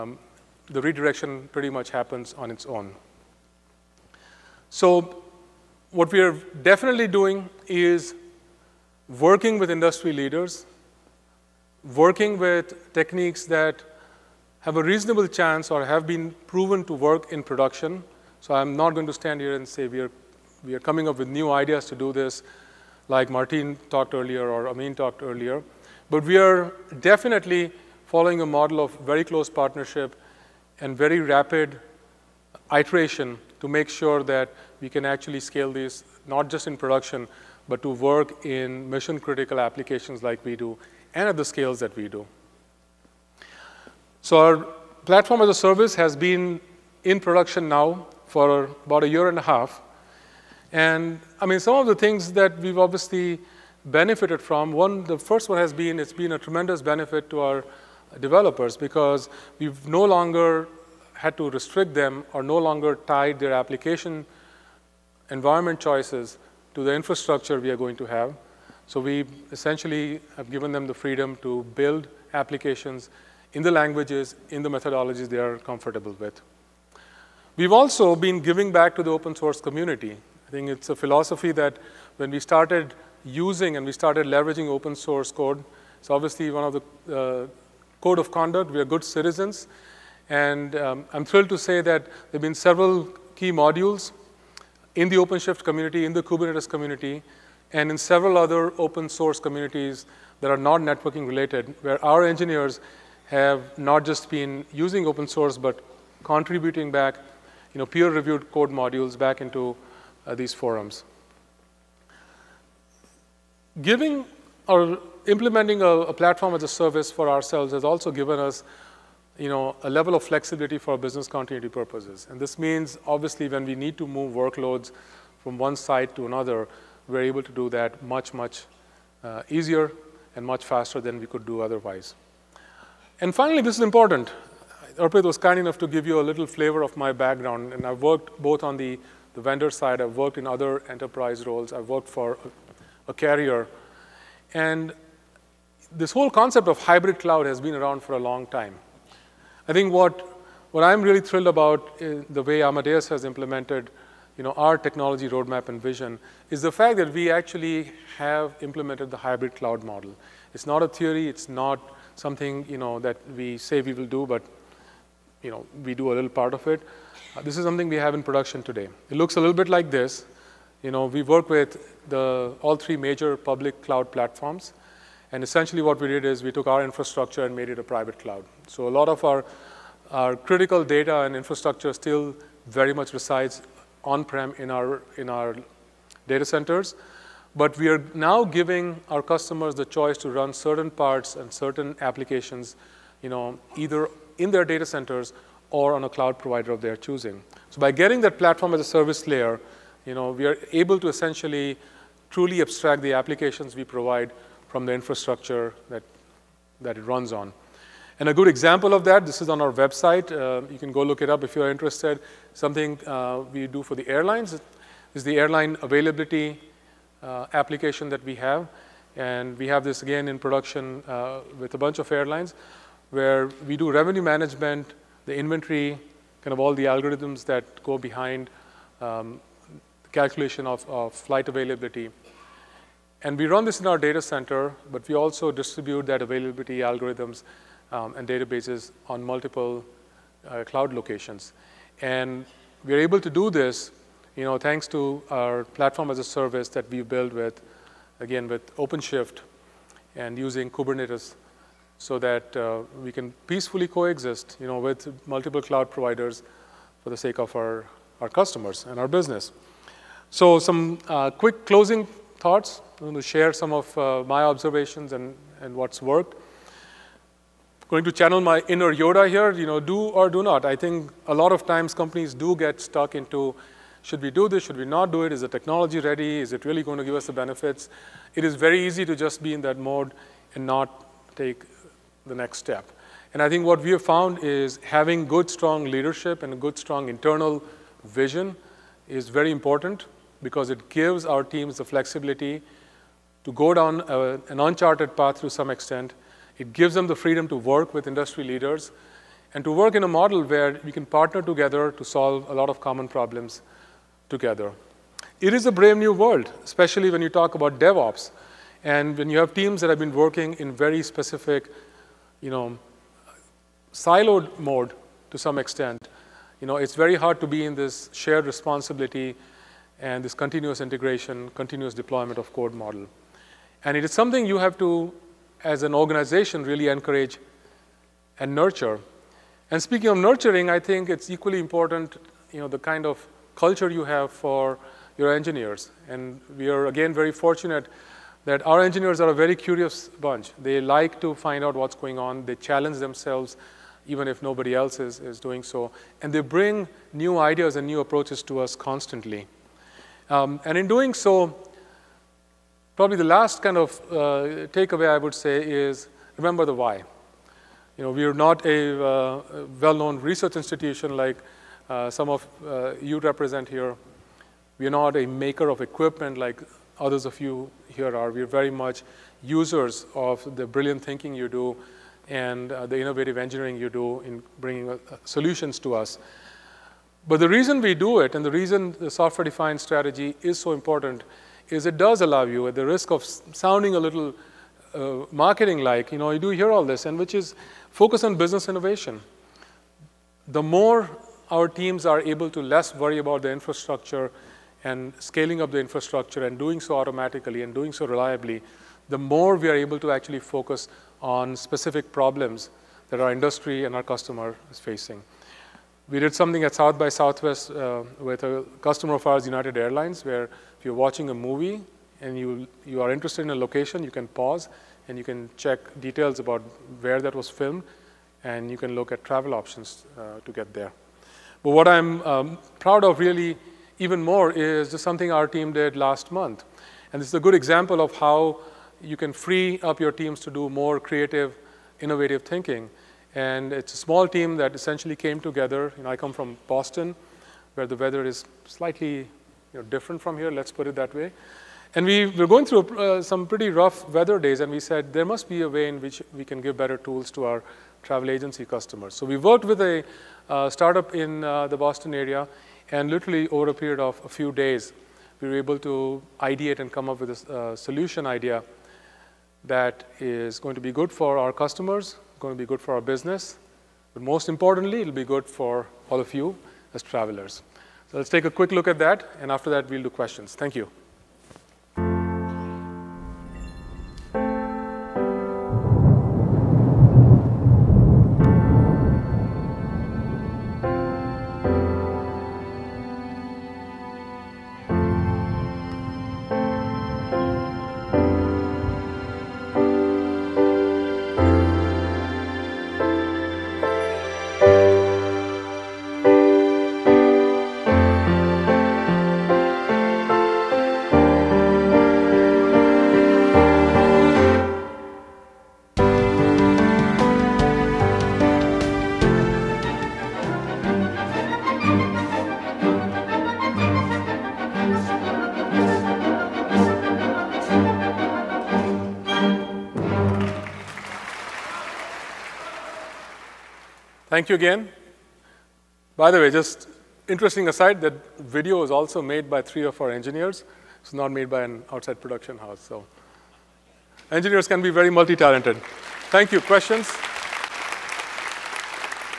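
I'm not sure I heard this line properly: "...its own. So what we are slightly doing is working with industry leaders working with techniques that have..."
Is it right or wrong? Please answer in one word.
wrong.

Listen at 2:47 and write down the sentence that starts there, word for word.
Uh, this is something we have in production today.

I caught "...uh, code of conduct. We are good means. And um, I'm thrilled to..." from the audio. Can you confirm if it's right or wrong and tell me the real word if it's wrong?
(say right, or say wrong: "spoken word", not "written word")
wrong: "citizens", not "means".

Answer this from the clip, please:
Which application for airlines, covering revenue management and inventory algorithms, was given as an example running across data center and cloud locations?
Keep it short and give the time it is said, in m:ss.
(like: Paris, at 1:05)
airline availability, at 3:35.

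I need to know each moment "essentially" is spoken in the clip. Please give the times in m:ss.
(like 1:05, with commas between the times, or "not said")
1:09, 2:55, 3:21, 7:14.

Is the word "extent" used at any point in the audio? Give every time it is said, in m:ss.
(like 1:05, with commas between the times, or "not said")
4:55, 5:15.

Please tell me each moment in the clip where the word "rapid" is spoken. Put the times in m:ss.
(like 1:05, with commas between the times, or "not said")
0:31.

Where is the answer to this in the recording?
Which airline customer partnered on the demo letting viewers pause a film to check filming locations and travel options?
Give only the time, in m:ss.
6:49.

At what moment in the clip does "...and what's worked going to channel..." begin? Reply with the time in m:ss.
4:25.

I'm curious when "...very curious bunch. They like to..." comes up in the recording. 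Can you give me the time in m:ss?
5:39.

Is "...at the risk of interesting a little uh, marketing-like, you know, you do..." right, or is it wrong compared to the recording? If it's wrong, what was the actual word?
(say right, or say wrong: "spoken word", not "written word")
wrong: "sounding", not "interesting".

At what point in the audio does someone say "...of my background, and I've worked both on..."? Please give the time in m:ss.
2:16.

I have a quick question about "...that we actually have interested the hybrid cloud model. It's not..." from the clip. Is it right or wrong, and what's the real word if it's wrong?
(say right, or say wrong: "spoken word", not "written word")
wrong: "implemented", not "interested".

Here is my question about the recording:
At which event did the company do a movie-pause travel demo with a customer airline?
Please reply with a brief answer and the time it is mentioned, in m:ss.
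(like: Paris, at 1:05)
South by Southwest, at 6:46.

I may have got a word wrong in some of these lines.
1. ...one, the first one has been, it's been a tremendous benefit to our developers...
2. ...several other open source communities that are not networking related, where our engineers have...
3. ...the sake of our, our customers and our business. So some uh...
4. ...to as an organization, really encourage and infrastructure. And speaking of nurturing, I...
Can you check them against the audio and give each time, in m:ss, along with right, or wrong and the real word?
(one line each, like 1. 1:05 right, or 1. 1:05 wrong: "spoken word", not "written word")
1. 0:54 right
2. 1:37 right
3. 4:17 right
4. 5:24 wrong: "nurture", not "infrastructure".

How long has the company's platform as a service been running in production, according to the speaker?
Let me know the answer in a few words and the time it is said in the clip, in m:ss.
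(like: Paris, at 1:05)
about a year and a half, at 0:48.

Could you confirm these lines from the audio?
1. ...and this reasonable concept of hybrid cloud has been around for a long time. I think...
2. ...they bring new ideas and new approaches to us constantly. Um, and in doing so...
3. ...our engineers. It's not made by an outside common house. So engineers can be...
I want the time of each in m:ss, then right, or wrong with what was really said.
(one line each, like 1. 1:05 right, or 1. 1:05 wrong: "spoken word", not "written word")
1. 2:24 wrong: "whole", not "reasonable"
2. 5:46 right
3. 8:49 wrong: "production", not "common".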